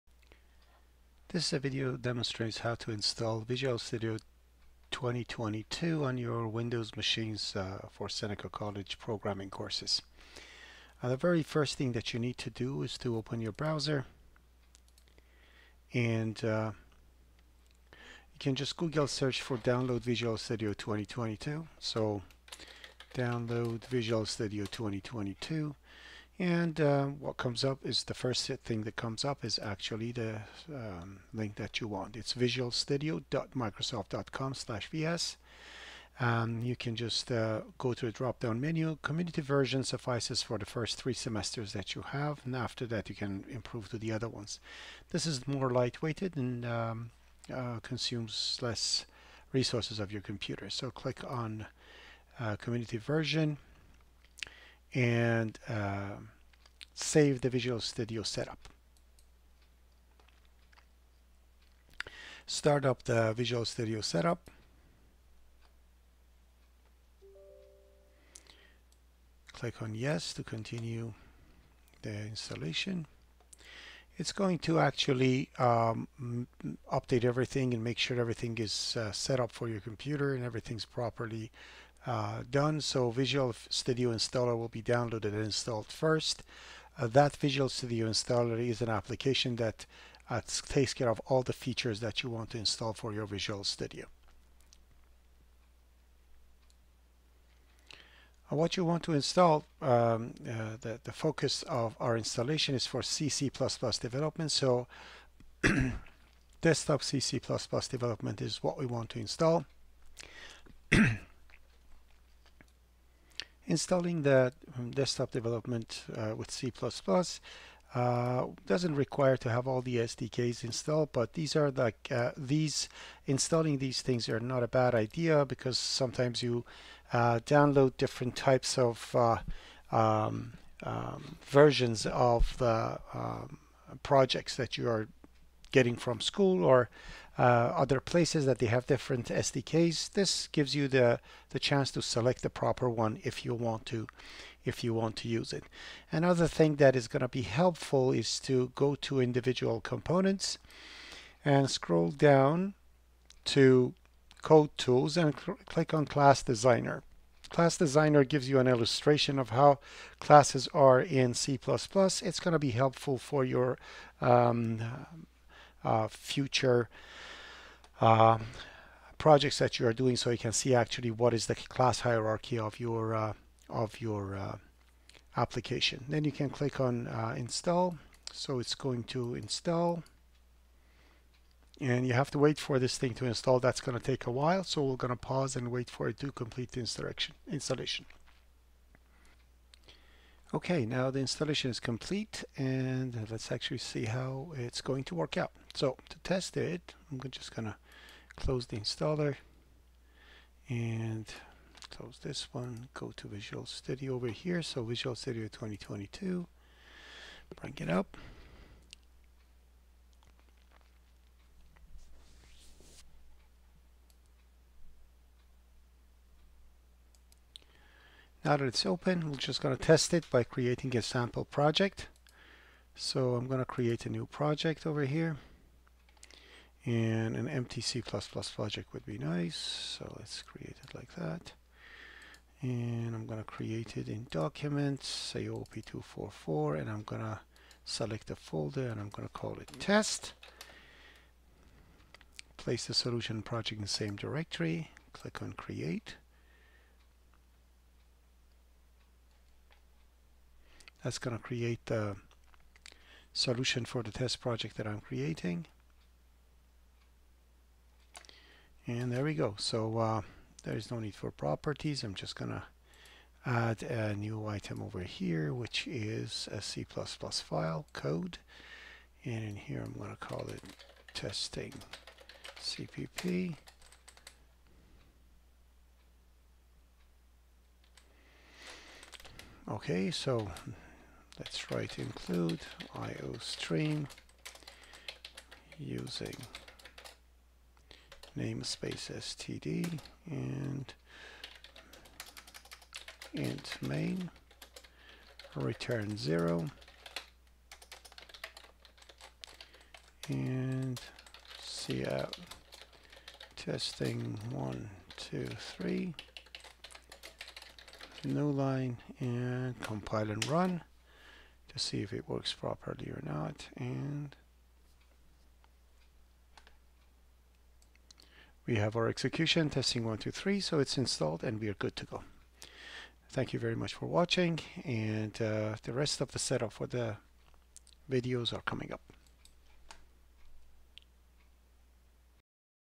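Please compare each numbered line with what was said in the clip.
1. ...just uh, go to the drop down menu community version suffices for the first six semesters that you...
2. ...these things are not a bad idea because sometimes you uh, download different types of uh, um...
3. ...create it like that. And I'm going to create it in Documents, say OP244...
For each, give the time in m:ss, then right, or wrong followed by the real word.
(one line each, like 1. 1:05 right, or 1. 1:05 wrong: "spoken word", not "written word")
1. 0:36 wrong: "three", not "six"
2. 2:03 right
3. 3:50 right.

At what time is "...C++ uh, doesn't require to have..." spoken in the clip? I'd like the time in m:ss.
1:56.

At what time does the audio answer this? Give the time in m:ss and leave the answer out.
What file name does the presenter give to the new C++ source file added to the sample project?
4:31.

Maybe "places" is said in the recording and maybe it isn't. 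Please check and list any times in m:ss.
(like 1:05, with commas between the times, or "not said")
2:17, 4:02.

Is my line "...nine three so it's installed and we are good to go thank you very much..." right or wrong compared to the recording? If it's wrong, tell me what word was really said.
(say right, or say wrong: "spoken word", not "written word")
wrong: "two", not "nine".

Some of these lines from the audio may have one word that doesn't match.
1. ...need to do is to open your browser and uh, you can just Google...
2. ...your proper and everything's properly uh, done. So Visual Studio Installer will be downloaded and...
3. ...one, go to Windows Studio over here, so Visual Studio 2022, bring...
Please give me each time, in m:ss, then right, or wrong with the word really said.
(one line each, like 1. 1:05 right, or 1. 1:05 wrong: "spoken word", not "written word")
1. 0:12 right
2. 1:19 wrong: "computer", not "proper"
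3. 3:22 wrong: "Visual", not "Windows".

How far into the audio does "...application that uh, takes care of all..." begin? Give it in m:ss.
1:28.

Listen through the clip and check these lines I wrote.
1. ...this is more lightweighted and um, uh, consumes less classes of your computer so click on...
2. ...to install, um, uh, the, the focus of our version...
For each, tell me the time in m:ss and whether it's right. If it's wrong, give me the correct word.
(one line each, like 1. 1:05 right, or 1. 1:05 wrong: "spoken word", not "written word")
1. 0:45 wrong: "resources", not "classes"
2. 1:39 wrong: "installation", not "version".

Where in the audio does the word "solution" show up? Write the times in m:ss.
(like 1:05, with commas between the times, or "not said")
4:02, 4:13.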